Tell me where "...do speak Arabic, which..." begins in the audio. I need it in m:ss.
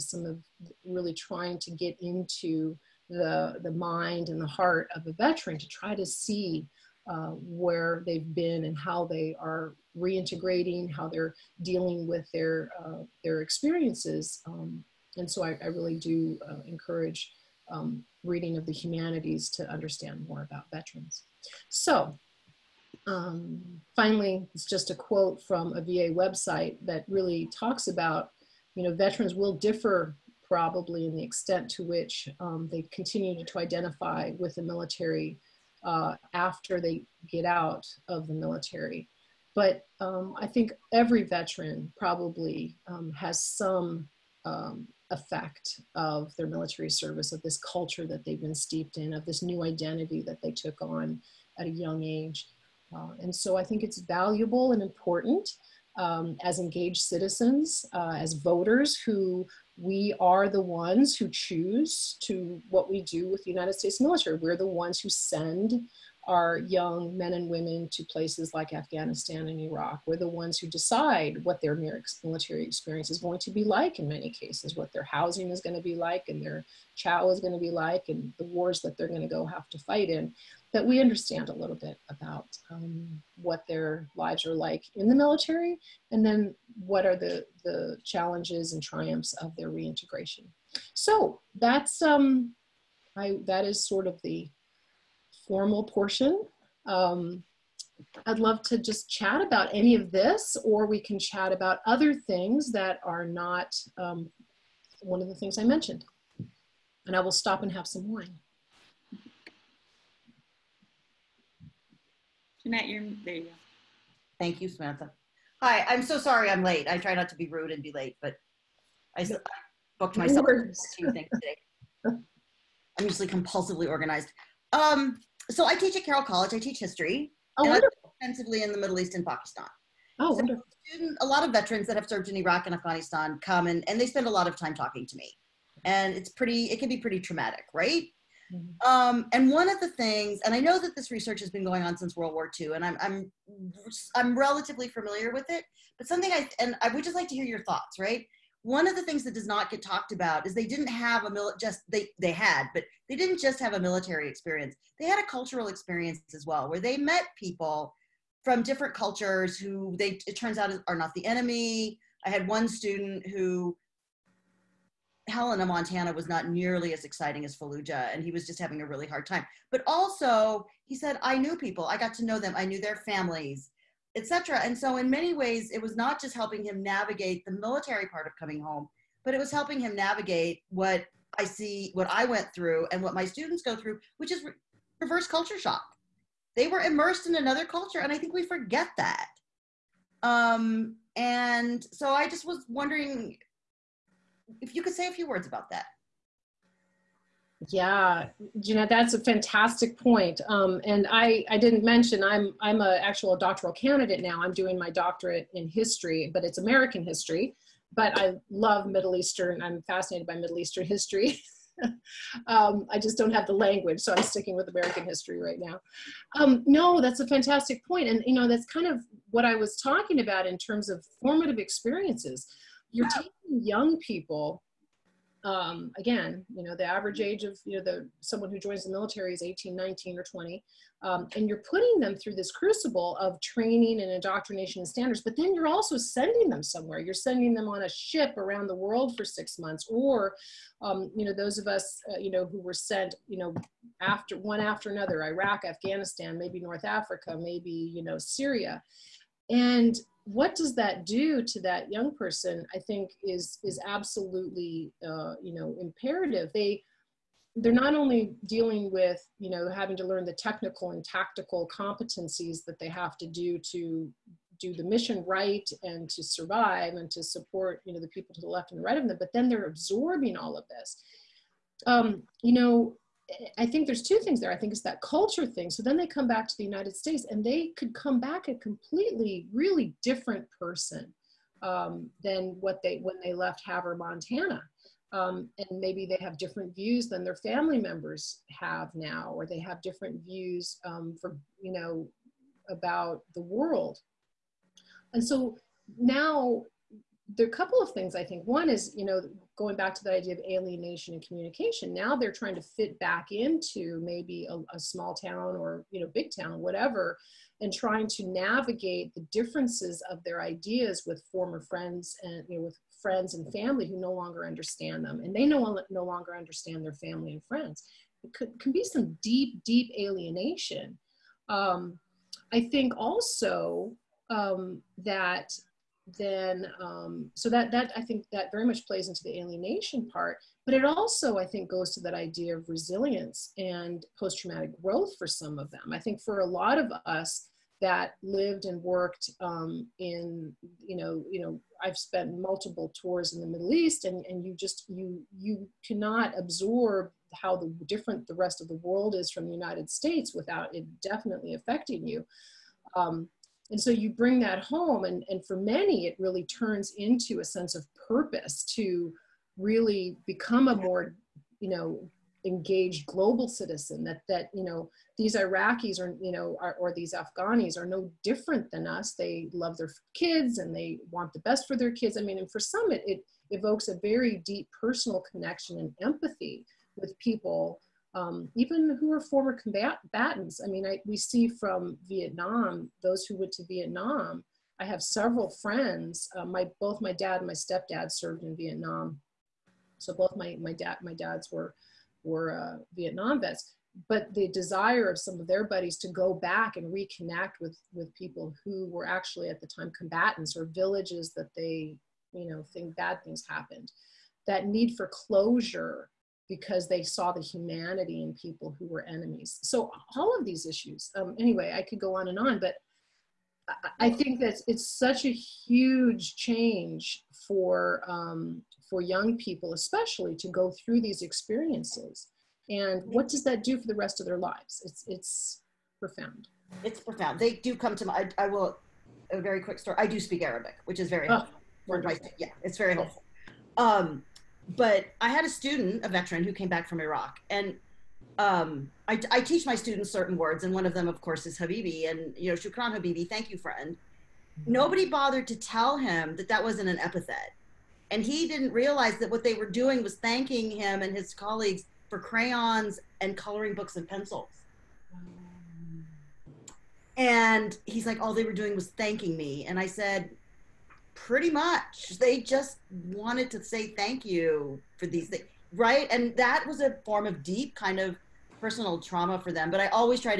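7:10.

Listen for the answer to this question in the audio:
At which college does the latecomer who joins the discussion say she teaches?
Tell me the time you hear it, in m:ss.
2:06.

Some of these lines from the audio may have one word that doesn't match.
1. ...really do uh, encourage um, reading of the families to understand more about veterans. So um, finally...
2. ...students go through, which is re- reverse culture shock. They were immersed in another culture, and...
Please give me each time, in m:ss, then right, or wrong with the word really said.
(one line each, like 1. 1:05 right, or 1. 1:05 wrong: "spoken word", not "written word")
1. 0:15 wrong: "humanities", not "families"
2. 3:03 right.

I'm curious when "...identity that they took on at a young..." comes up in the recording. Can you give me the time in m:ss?
0:49.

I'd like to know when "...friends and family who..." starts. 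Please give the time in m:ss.
5:13.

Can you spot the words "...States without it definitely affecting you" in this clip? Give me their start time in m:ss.
5:49.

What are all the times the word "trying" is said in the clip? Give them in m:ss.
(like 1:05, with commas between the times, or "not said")
0:01, 5:02, 5:07.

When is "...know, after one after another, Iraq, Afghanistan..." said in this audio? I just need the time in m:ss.
4:03.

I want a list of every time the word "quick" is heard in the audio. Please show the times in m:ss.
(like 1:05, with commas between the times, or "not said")
7:09.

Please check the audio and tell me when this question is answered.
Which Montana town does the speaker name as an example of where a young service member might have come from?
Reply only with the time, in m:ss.
4:43.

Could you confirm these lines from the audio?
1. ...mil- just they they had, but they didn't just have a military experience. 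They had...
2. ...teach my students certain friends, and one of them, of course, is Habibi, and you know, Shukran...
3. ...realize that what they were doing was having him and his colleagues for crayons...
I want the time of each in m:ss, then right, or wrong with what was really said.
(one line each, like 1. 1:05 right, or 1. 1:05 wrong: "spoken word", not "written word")
1. 2:31 right
2. 7:19 wrong: "words", not "friends"
3. 7:28 wrong: "thanking", not "having".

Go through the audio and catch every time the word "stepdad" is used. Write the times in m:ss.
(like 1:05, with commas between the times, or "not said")
6:27.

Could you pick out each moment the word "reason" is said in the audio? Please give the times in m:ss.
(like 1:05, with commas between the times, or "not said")
not said.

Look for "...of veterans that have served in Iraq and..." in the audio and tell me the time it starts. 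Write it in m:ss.
2:11.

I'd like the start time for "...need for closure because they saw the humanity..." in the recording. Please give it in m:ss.
6:44.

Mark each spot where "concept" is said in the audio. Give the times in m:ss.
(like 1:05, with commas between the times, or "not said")
not said.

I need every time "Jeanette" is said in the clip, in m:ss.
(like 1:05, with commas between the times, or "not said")
1:52, 3:18.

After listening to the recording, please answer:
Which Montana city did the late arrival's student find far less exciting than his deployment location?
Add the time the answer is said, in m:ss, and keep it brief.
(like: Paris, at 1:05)
Helena, at 2:45.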